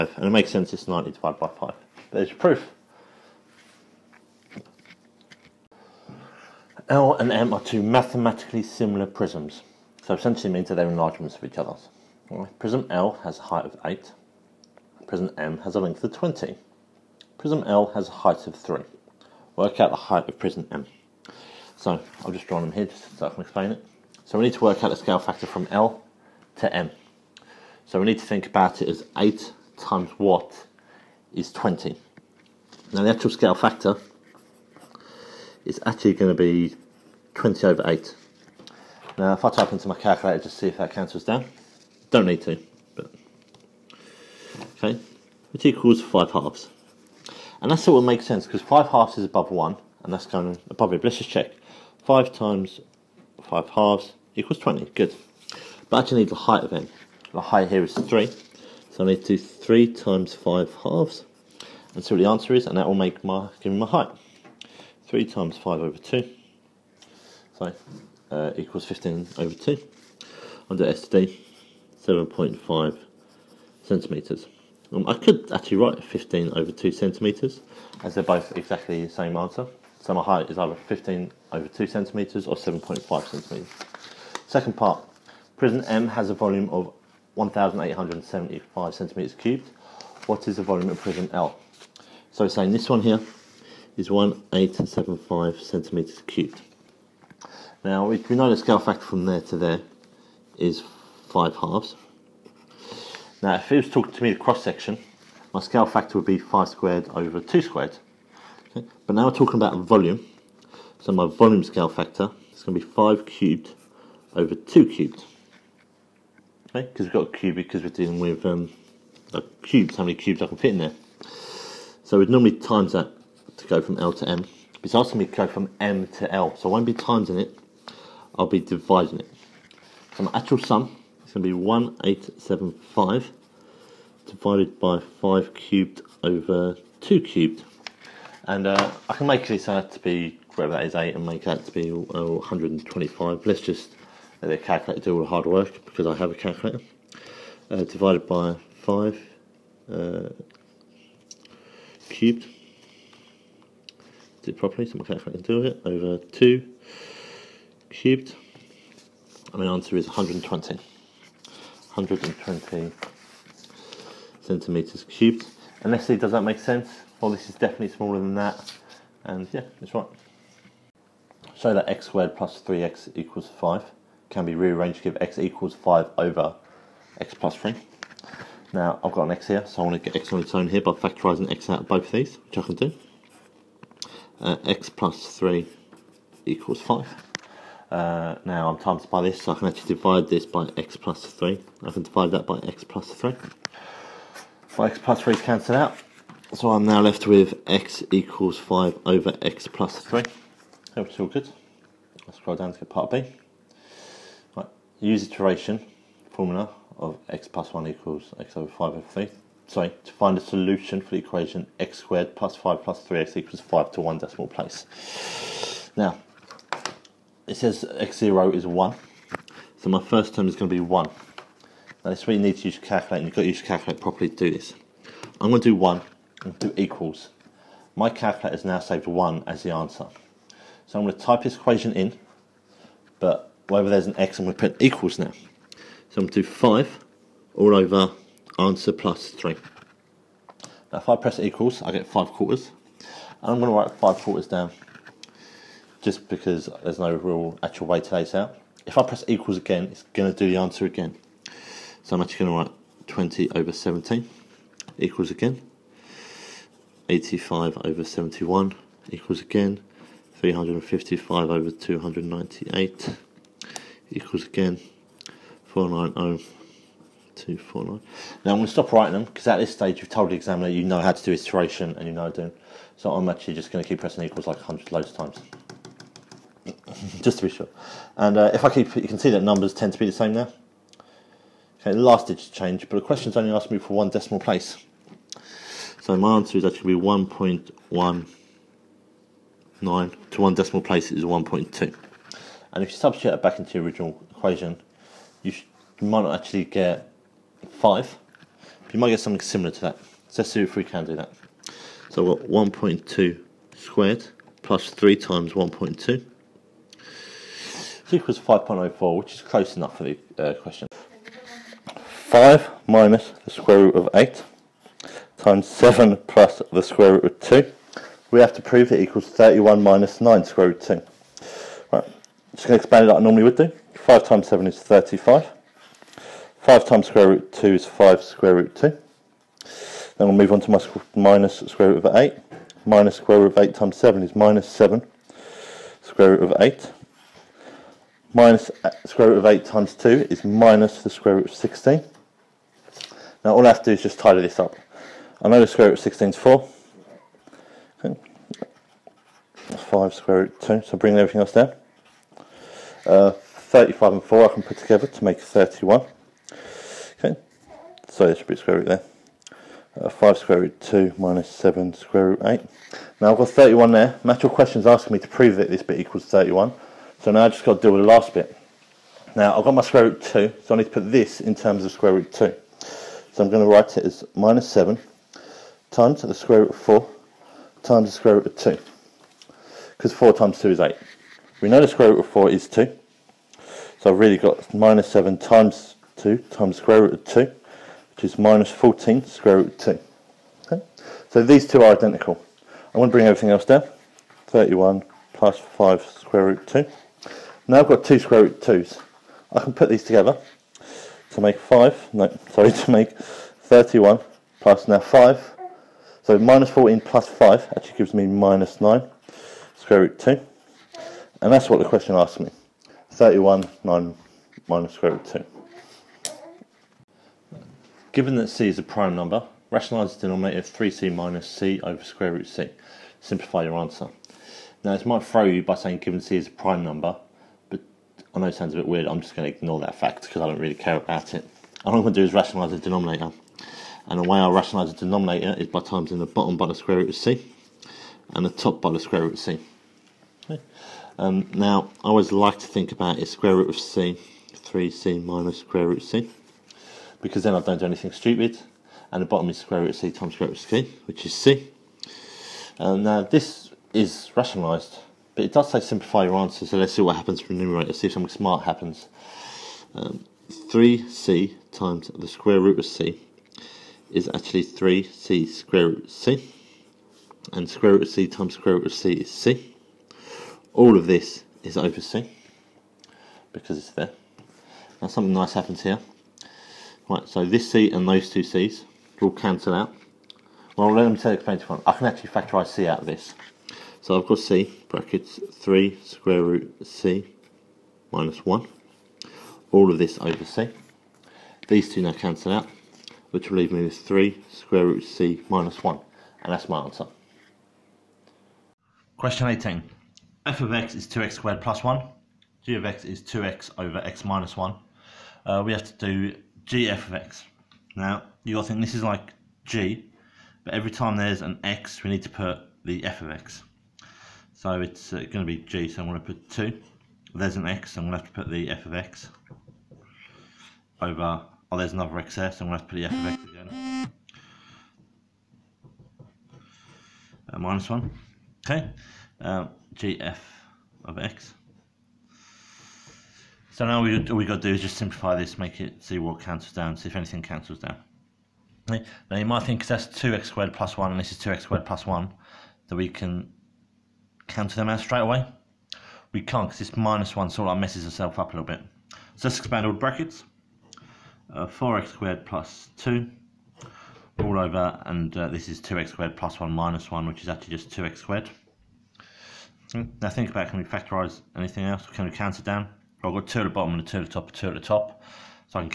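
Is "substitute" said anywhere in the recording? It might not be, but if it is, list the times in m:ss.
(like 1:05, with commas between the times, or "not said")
4:52.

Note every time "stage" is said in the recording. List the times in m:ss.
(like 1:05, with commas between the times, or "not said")
4:29.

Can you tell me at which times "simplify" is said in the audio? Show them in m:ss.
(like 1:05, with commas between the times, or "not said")
7:03, 7:35, 8:54.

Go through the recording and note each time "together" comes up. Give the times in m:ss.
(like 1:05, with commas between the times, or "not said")
5:54, 6:40.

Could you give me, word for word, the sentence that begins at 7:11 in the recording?
All I'm going to do is rationalise the denominator.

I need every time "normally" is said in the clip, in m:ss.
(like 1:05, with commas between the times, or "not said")
2:02, 5:23.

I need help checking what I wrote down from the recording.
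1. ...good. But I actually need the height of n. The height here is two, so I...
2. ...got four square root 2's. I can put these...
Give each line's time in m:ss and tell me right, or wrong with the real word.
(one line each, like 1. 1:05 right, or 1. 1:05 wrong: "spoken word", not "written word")
1. 0:54 wrong: "three", not "two"
2. 6:37 wrong: "two", not "four".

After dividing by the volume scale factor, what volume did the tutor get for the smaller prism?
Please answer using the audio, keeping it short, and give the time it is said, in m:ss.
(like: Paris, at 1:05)
120 cubic centimeters, at 2:40.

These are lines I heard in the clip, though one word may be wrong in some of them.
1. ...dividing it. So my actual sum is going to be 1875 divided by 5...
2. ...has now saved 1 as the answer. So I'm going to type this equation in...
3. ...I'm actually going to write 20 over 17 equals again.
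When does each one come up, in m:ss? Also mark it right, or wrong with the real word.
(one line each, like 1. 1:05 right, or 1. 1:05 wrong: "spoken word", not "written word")
1. 2:08 right
2. 3:48 right
3. 4:12 right.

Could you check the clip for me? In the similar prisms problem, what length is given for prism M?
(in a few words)
20.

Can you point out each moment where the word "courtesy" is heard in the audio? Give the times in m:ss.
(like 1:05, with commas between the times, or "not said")
not said.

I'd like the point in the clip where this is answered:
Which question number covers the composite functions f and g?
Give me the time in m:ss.
8:19.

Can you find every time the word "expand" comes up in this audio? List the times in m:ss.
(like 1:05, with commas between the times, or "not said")
5:22, 9:09.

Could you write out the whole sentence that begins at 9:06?
We can't because this minus 1 sort of messes itself up a little bit.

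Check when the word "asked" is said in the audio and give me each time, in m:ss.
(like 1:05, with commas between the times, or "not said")
4:43, 6:52.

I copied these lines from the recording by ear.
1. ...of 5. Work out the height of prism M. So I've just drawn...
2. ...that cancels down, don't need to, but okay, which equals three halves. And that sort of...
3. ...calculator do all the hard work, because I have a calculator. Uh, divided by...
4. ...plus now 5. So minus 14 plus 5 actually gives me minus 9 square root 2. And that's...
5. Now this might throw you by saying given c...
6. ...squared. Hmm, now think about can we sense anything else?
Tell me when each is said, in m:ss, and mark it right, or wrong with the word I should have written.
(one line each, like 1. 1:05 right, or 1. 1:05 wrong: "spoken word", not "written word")
1. 0:18 wrong: "3", not "5"
2. 0:40 wrong: "five", not "three"
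3. 2:24 right
4. 6:44 right
5. 7:04 right
6. 9:18 wrong: "factorise", not "sense".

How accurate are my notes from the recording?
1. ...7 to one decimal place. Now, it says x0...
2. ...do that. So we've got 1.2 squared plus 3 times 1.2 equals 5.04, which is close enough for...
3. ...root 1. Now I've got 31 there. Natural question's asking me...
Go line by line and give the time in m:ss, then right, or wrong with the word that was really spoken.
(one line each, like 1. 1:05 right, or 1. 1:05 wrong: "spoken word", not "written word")
1. 3:33 wrong: "5", not "7"
2. 5:01 right
3. 6:02 wrong: "8", not "1".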